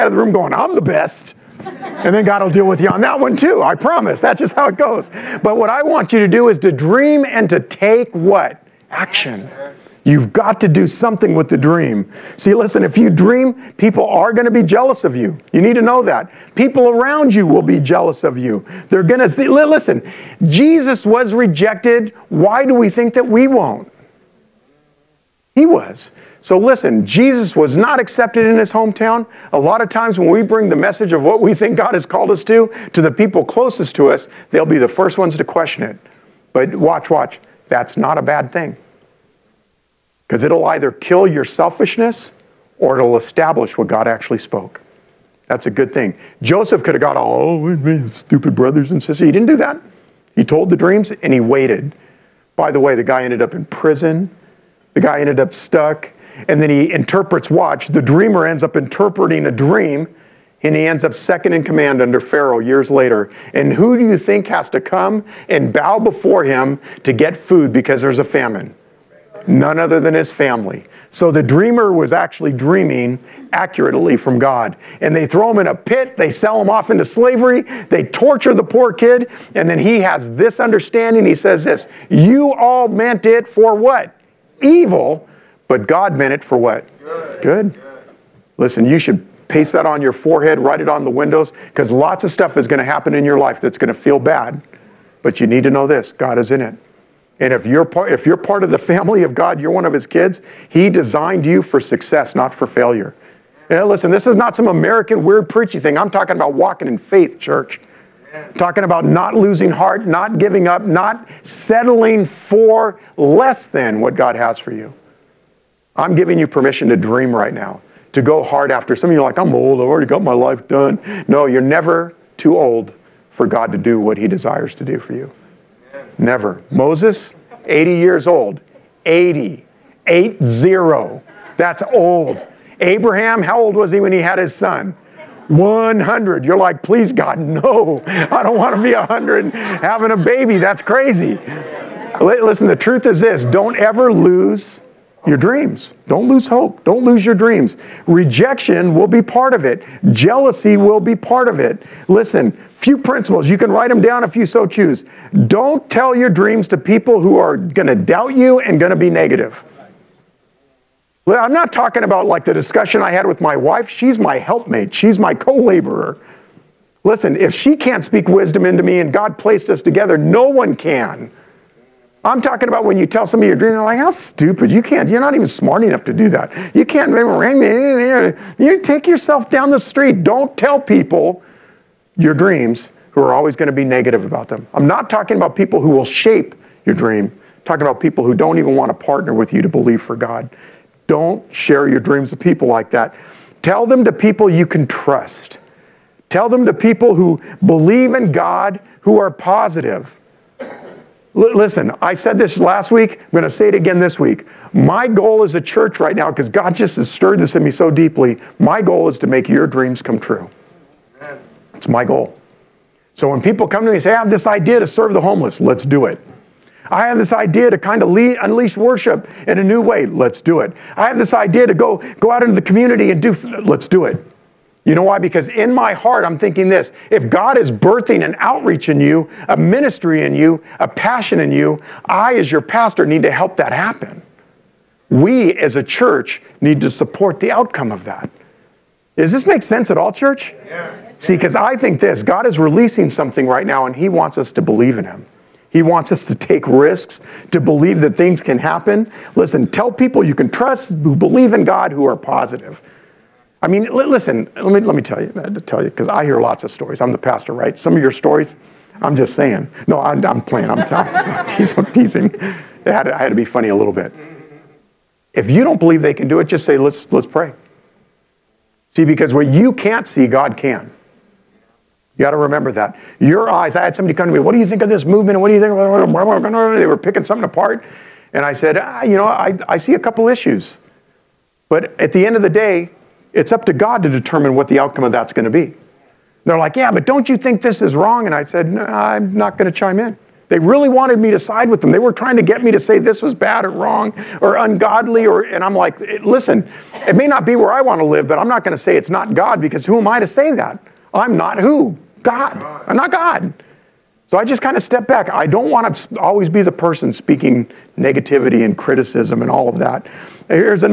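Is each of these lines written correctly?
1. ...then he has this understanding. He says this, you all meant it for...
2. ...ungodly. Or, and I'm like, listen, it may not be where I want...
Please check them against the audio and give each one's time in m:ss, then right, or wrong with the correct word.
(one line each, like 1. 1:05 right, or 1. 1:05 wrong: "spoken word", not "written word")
1. 1:19 right
2. 4:54 right.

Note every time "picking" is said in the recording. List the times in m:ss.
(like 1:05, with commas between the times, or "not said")
4:36.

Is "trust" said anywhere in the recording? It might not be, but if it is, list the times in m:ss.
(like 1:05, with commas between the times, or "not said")
3:14, 4:10.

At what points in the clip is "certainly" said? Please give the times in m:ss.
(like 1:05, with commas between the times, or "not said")
not said.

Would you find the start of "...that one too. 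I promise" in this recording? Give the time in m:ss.
0:03.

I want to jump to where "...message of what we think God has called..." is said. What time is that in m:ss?
0:30.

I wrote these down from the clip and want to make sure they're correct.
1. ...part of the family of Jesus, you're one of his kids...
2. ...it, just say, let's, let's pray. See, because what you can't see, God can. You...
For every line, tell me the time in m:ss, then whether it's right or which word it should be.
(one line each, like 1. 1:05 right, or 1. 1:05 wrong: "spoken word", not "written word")
1. 1:38 wrong: "God", not "Jesus"
2. 4:26 right.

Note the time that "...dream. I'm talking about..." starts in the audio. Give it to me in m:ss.
3:06.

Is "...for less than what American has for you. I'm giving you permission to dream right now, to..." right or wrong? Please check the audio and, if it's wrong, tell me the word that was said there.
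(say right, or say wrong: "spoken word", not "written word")
wrong: "God", not "American".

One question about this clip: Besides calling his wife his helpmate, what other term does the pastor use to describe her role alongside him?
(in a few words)
co-laborer.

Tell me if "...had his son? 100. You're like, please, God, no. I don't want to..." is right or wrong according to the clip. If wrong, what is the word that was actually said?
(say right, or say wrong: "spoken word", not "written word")
right.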